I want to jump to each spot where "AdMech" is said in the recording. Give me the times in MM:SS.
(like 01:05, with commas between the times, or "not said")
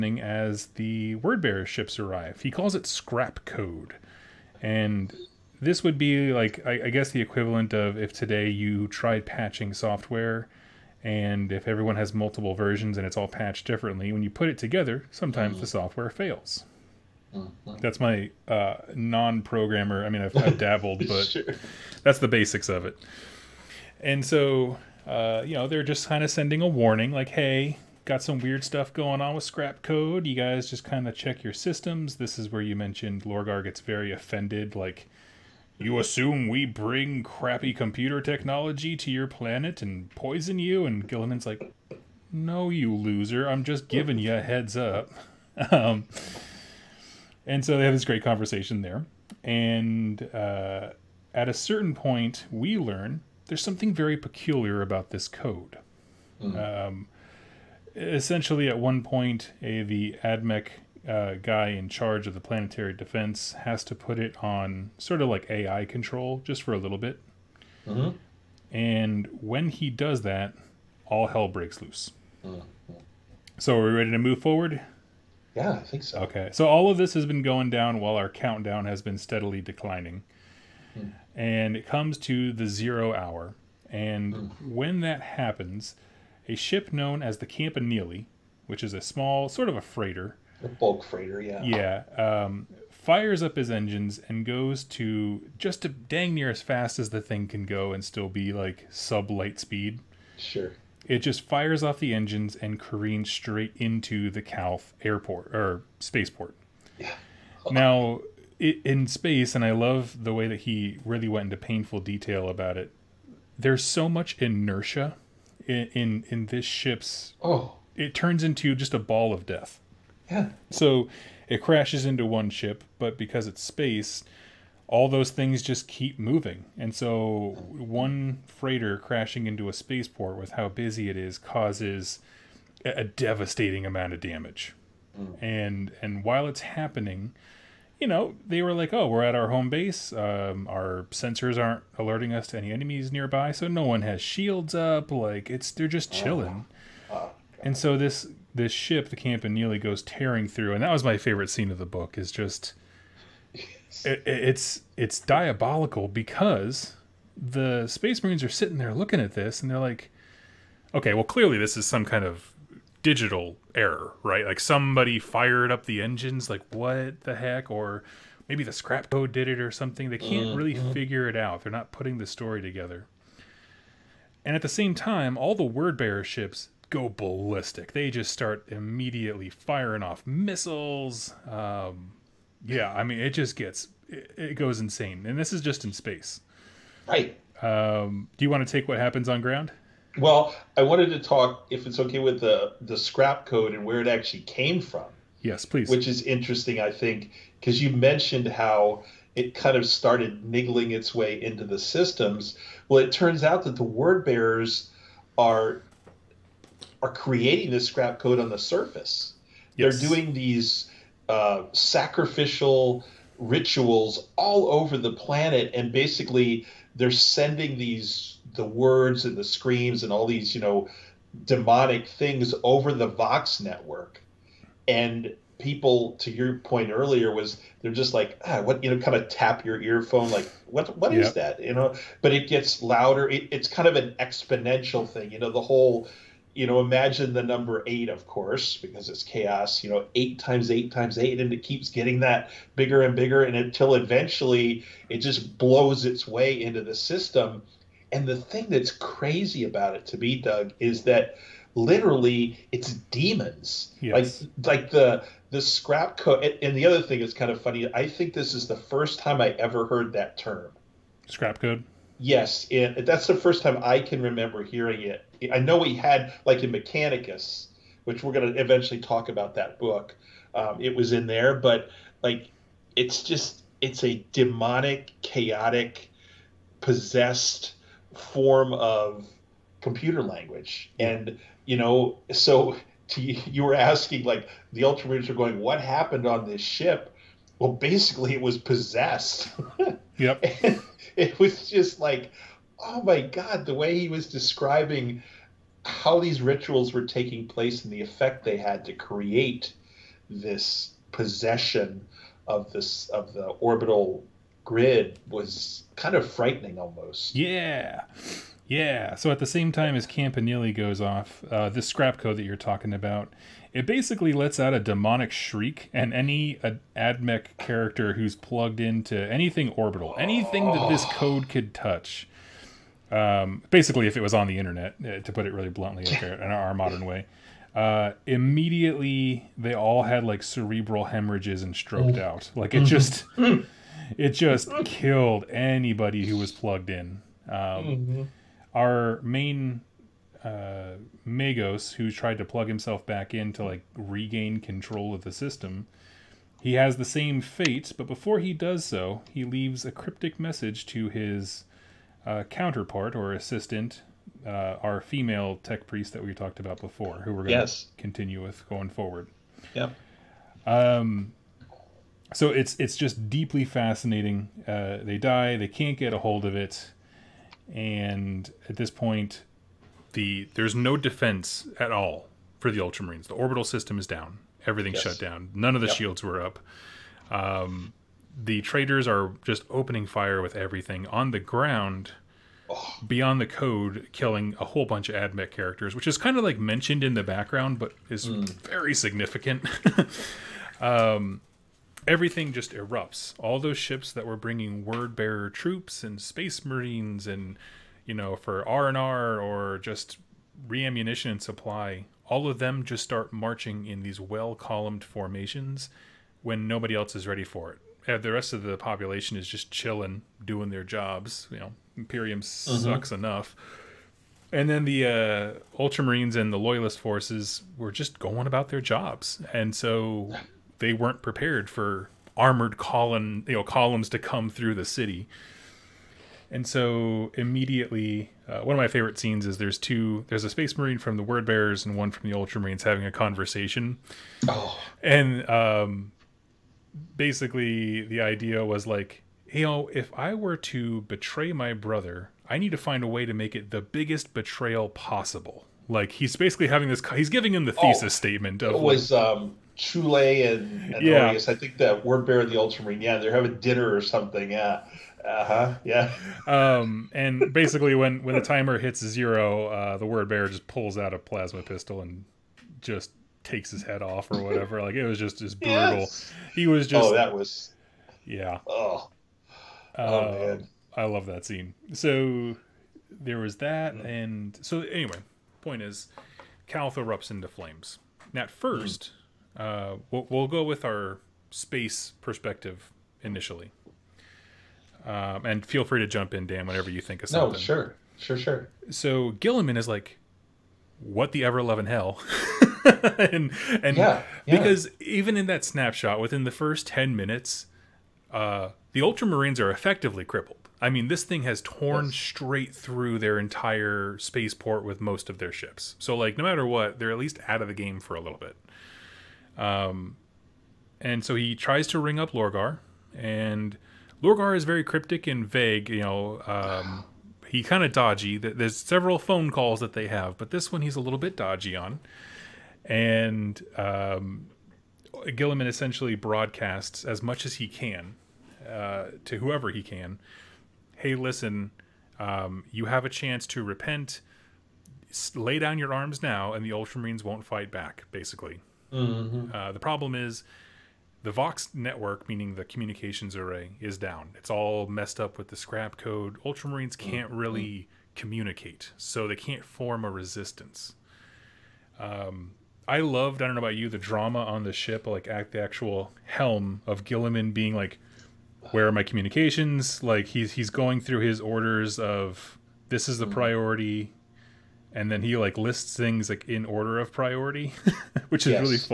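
01:00, 05:16, 06:25.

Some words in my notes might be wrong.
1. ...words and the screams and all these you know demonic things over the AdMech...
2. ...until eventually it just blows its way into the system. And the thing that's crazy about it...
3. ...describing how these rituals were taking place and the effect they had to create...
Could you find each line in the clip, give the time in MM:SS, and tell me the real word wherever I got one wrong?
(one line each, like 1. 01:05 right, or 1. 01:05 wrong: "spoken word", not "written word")
1. 03:38 wrong: "Vox", not "AdMech"
2. 04:03 right
3. 04:54 right.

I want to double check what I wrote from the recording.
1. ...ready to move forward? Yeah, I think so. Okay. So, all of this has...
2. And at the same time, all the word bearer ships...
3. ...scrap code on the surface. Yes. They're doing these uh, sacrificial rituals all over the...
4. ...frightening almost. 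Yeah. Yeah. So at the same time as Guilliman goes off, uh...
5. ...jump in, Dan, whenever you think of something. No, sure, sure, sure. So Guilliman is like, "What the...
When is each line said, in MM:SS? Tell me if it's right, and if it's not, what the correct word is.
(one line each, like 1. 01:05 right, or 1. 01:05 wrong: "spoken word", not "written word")
1. 01:13 right
2. 02:54 right
3. 03:27 right
4. 05:06 wrong: "Campanile", not "Guilliman"
5. 08:06 right.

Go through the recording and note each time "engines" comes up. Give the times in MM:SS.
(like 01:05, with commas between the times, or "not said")
01:33, 01:42, 02:46.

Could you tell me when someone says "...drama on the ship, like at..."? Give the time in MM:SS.
09:13.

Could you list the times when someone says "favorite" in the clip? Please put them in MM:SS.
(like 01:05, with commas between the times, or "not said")
02:31, 07:08.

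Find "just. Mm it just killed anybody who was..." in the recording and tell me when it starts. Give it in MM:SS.
05:32.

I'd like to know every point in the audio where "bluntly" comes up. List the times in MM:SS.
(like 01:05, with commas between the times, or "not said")
05:25.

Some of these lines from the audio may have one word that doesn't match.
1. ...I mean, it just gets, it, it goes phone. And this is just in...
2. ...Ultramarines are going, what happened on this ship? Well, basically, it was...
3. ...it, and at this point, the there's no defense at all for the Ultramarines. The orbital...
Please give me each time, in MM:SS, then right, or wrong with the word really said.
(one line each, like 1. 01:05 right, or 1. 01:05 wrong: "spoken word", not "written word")
1. 03:02 wrong: "insane", not "phone"
2. 04:44 right
3. 06:06 right.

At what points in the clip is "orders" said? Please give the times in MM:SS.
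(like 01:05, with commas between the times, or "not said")
09:21, 09:26.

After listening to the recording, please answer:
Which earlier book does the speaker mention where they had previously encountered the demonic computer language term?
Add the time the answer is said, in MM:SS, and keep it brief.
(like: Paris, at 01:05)
Mechanicus, at 04:26.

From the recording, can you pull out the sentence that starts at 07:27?
thesis oh, statement of it was like, um Chule and, and yeah.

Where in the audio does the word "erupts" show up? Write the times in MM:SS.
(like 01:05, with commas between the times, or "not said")
06:32, 07:56.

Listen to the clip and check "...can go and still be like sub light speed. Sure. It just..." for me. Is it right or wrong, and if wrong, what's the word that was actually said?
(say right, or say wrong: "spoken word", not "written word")
right.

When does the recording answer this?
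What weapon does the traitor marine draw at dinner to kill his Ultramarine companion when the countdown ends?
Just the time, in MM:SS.
07:41.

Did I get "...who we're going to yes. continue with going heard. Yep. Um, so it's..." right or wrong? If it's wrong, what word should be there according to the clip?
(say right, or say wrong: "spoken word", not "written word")
wrong: "forward", not "heard".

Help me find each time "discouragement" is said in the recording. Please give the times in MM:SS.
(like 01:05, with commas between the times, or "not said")
not said.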